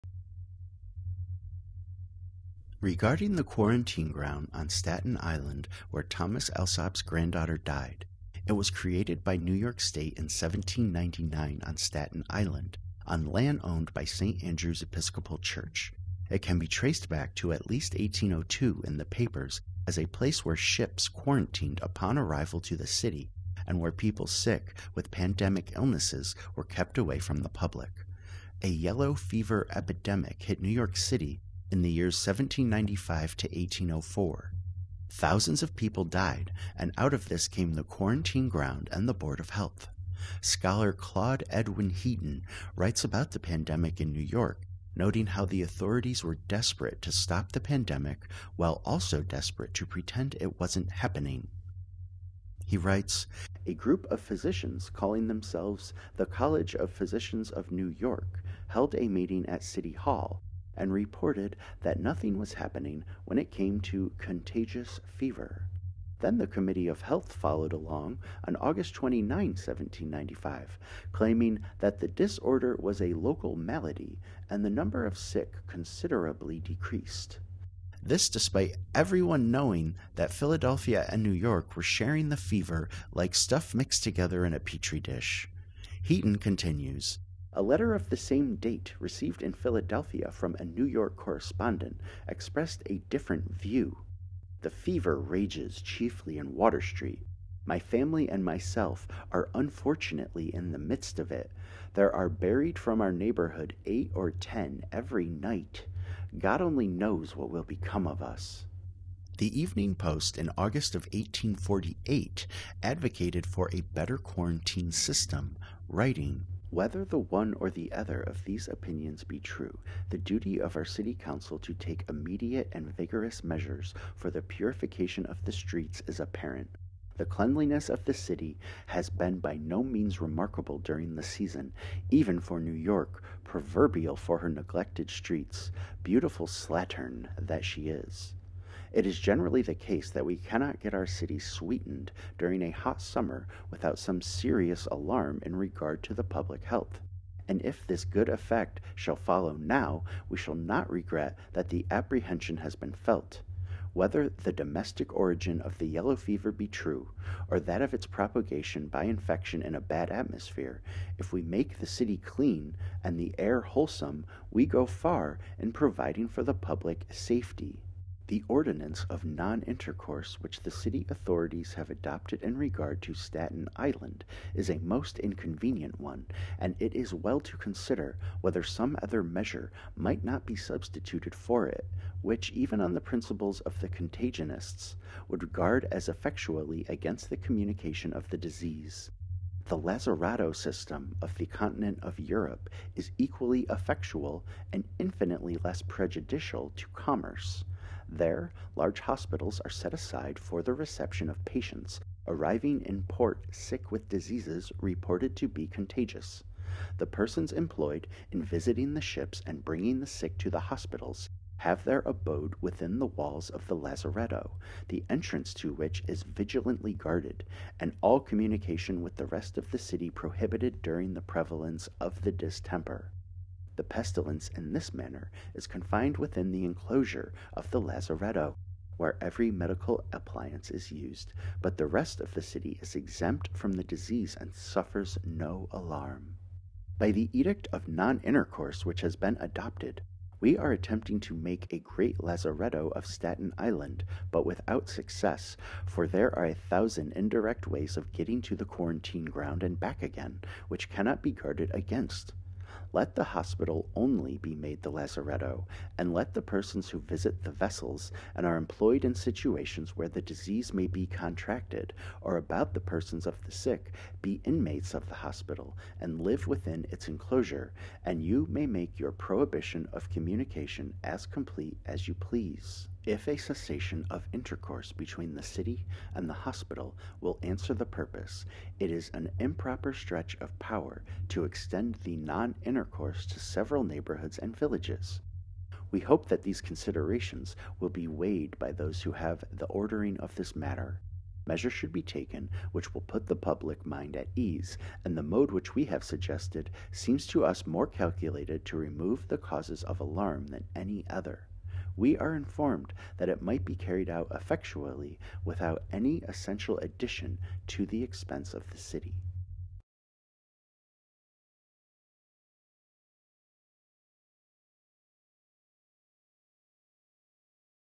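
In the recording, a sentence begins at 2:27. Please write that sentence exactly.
And if this good effect shall follow now, we shall not regret that the apprehension has been felt.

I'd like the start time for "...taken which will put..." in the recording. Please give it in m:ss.
4:52.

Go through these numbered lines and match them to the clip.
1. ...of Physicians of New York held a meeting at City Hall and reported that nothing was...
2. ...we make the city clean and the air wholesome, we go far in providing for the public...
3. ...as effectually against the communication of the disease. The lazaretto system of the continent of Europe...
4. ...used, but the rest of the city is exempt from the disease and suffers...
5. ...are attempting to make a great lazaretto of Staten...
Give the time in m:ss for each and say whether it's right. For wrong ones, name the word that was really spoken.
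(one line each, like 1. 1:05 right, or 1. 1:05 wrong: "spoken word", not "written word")
1. 0:56 right
2. 2:41 right
3. 3:05 right
4. 3:50 right
5. 4:00 right.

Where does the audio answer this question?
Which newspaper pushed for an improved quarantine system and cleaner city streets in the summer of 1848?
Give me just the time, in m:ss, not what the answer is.
1:49.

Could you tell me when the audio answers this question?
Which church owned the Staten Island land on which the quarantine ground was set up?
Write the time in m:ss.
0:14.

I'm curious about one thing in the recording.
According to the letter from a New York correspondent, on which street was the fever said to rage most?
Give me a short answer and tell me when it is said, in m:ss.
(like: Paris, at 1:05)
Water Street, at 1:36.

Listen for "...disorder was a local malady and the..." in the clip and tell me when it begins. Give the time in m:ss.
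1:12.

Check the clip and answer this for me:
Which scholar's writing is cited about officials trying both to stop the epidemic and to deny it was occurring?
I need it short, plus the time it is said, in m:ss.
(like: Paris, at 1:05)
Claude Edwin Heaton, at 0:40.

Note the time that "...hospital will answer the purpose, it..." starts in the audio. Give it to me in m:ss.
4:36.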